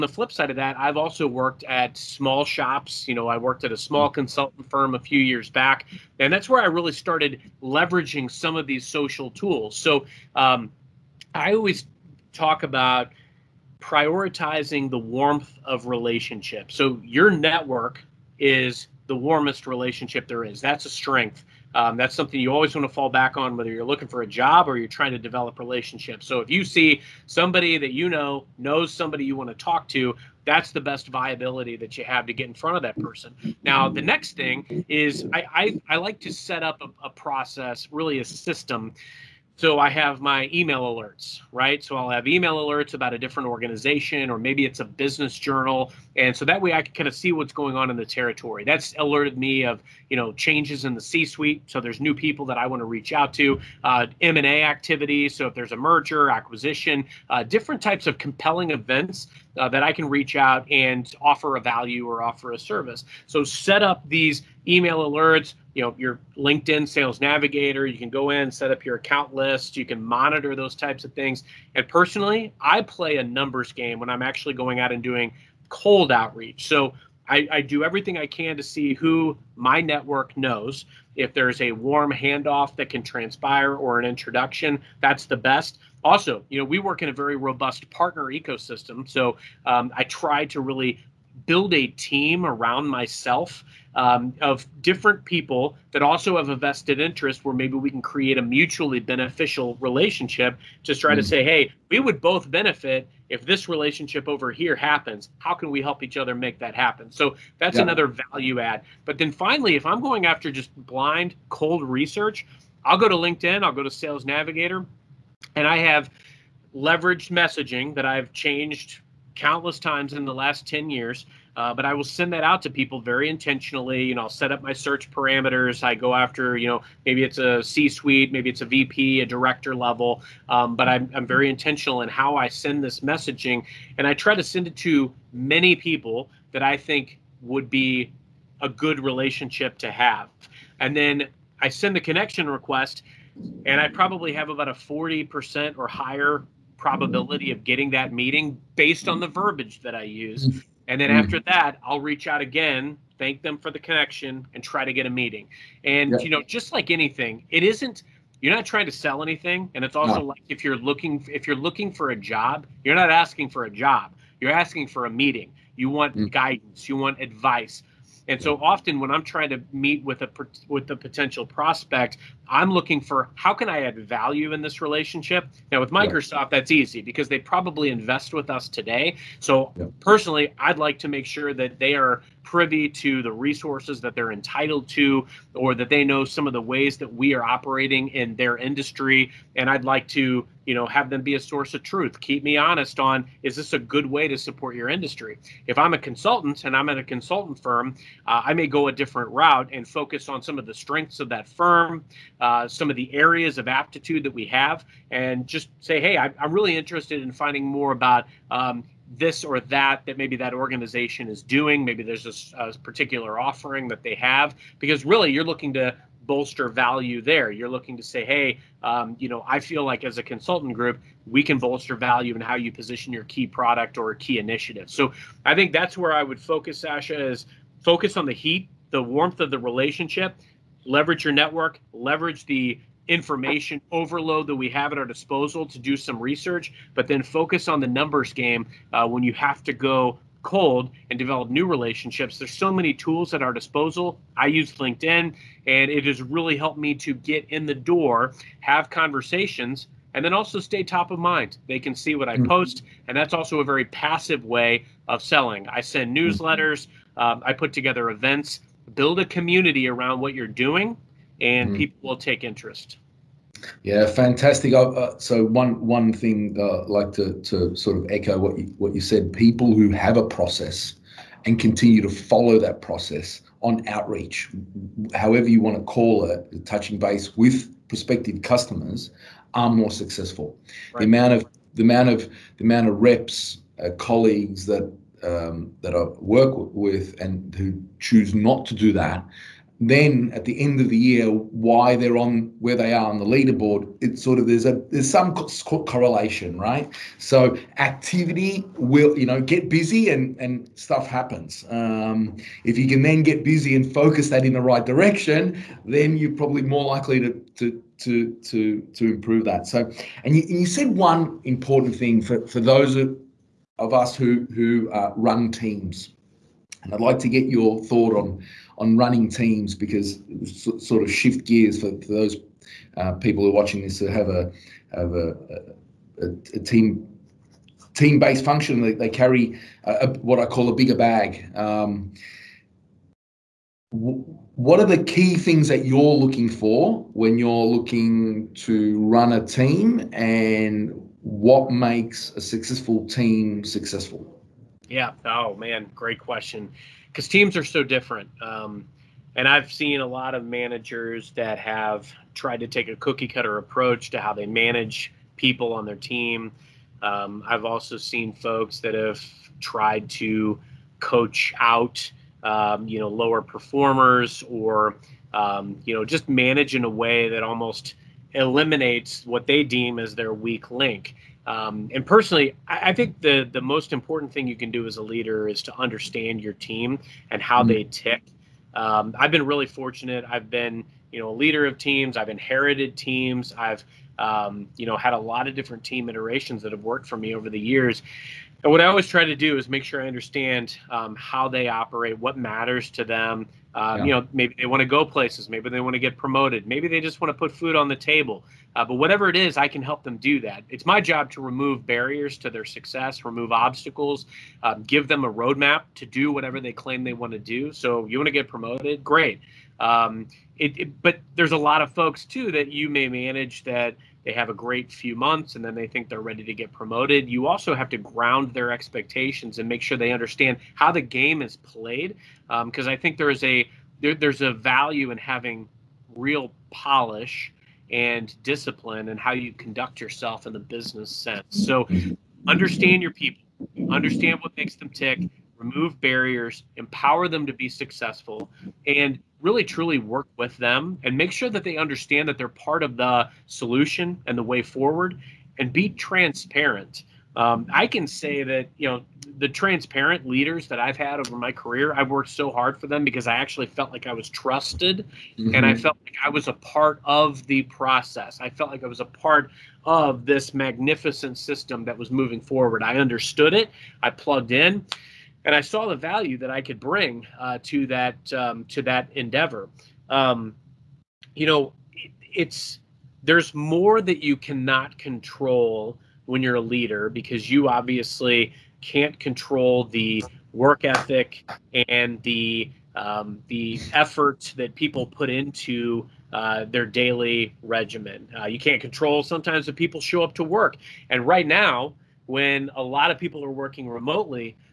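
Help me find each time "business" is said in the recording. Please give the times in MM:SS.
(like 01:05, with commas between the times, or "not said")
00:44, 07:10.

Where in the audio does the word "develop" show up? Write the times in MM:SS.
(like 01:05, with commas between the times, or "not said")
00:25, 04:01.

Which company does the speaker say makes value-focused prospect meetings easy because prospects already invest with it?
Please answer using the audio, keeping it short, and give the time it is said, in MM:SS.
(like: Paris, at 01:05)
Microsoft, at 02:55.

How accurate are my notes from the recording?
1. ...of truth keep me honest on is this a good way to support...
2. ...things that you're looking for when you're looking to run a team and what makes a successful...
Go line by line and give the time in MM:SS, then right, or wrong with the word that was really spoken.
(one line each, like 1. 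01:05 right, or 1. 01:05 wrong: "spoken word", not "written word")
1. 03:11 right
2. 05:35 right.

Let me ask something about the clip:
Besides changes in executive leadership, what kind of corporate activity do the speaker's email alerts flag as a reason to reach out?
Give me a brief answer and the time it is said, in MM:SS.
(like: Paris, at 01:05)
M&A activity, at 00:54.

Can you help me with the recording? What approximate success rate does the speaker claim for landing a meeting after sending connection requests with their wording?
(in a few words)
40%.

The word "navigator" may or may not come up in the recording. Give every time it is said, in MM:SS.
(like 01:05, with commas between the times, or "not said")
01:07, 01:54.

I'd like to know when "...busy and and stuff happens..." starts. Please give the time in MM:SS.
04:59.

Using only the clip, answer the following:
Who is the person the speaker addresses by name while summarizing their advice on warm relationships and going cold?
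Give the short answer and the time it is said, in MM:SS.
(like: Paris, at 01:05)
Sasha, at 03:46.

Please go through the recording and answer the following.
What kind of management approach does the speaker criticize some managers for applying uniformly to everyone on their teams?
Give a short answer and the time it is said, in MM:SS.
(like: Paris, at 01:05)
cookie cutter approach, at 05:52.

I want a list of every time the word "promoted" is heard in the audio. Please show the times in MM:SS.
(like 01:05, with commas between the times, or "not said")
06:36, 06:48, 06:56.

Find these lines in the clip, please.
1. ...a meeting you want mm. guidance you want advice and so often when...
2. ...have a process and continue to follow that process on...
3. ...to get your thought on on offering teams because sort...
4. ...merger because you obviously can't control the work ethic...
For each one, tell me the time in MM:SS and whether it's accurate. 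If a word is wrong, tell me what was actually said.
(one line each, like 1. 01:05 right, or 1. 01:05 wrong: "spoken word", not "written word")
1. 02:45 right
2. 04:29 right
3. 05:17 wrong: "running", not "offering"
4. 07:56 wrong: "leader", not "merger".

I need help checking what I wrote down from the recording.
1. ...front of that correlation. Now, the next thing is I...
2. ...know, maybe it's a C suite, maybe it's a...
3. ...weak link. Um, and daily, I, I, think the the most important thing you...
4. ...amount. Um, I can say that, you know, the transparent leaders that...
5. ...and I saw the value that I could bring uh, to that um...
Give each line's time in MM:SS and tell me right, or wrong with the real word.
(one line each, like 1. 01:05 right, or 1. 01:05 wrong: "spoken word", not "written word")
1. 00:32 wrong: "person", not "correlation"
2. 02:06 right
3. 06:10 wrong: "personally", not "daily"
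4. 07:25 wrong: "transparent", not "amount"
5. 07:45 right.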